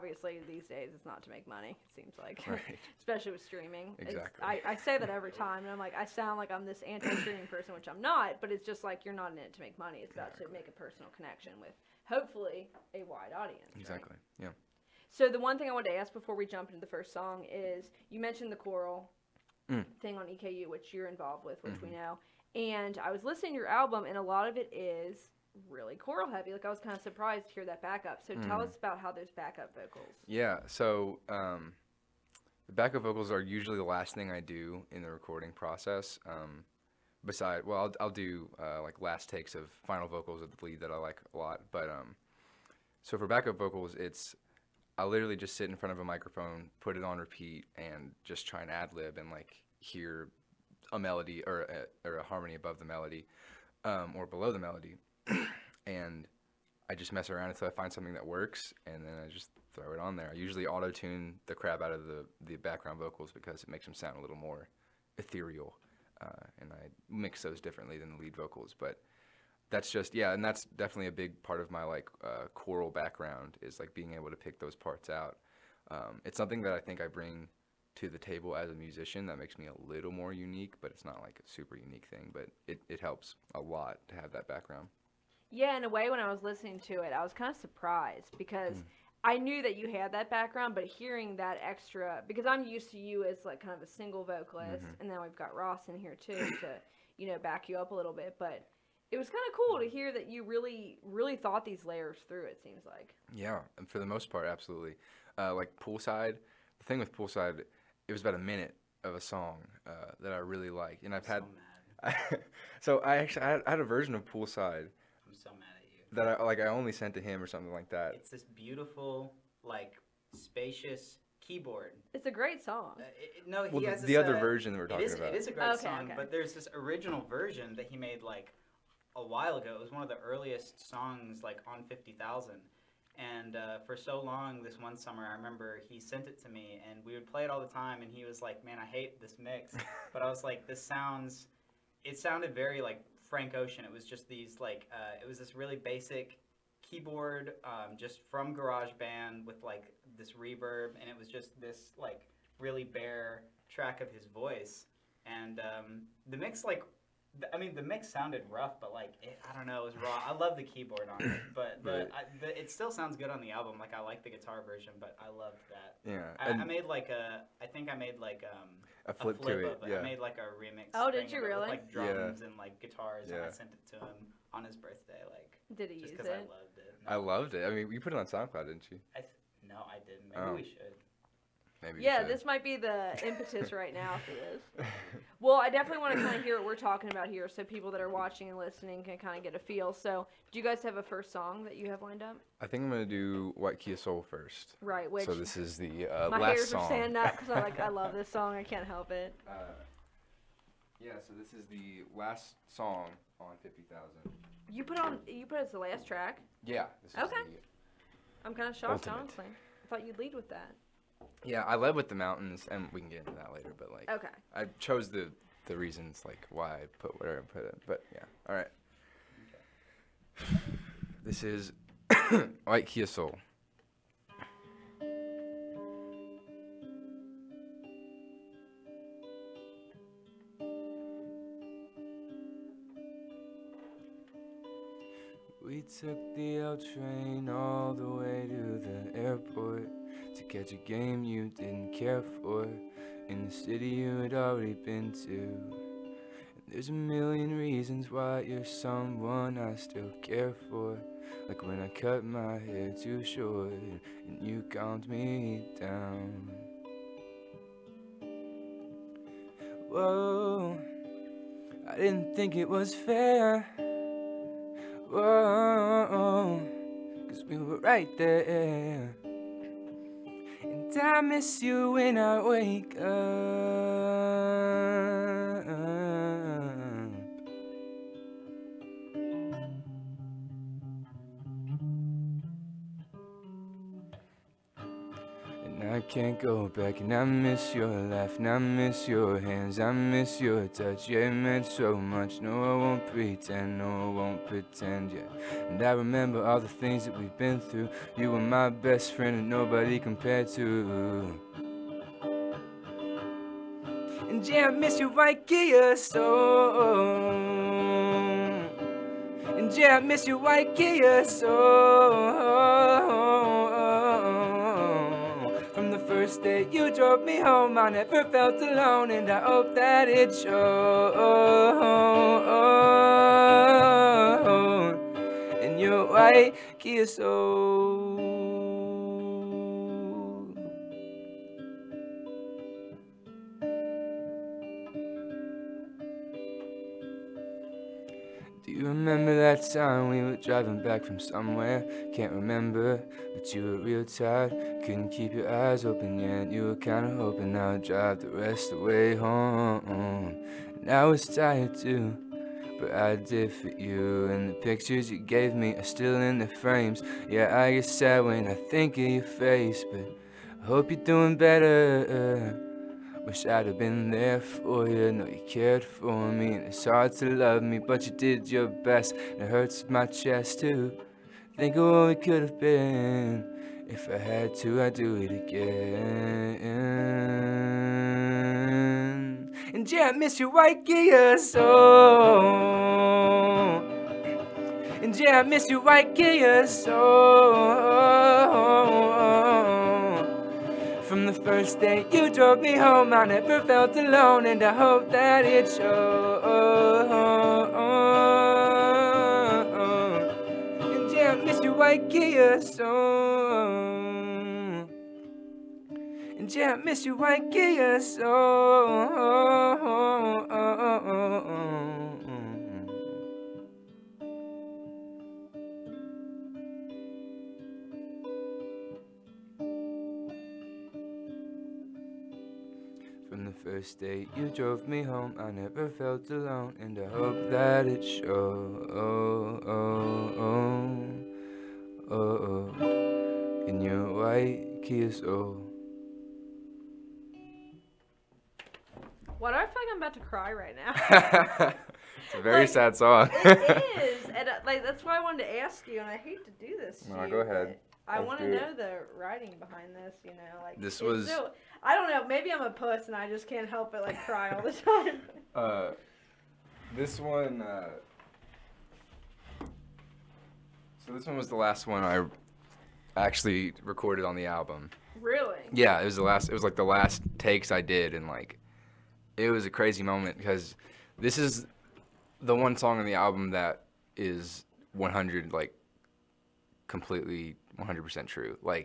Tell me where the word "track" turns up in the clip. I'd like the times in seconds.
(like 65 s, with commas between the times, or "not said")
153 s, 206 s.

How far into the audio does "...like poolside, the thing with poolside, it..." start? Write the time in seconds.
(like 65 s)
105 s.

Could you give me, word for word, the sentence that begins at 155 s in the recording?
And um, the mix like I mean, the mix sounded rough, but like it, I don't know, it was raw.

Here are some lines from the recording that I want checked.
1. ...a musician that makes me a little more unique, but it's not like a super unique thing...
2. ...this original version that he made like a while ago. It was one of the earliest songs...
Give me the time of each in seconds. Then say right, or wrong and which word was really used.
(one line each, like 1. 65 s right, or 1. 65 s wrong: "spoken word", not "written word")
1. 78 s right
2. 126 s right.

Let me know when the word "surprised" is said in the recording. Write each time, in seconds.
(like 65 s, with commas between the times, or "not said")
27 s, 87 s.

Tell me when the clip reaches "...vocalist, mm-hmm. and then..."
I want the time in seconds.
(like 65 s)
94 s.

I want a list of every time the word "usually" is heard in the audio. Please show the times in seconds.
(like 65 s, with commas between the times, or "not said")
33 s, 60 s.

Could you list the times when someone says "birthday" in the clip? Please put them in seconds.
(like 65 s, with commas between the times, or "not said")
174 s.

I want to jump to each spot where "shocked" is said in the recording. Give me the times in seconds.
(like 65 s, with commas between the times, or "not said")
208 s.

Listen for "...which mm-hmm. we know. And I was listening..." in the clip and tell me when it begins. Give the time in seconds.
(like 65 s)
21 s.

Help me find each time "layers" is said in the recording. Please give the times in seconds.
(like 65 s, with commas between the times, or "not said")
101 s.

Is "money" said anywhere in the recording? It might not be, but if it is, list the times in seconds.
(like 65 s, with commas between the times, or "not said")
1 s, 9 s.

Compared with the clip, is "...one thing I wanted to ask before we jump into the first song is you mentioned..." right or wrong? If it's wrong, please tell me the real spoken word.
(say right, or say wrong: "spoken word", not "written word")
right.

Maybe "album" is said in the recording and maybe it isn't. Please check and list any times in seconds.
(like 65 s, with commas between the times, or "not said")
23 s, 163 s, 464 s, 473 s.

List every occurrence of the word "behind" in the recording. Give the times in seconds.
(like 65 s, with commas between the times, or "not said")
449 s.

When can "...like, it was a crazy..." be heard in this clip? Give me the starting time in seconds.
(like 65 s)
468 s.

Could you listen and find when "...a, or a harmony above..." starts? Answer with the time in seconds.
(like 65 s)
51 s.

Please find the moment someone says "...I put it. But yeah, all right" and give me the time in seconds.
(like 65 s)
217 s.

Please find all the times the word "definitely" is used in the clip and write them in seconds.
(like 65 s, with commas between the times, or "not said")
70 s, 185 s.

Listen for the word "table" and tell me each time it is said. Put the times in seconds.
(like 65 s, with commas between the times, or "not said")
78 s.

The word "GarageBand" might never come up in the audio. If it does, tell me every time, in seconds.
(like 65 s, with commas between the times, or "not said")
148 s.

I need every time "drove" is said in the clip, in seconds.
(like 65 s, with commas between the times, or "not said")
316 s, 392 s, 424 s.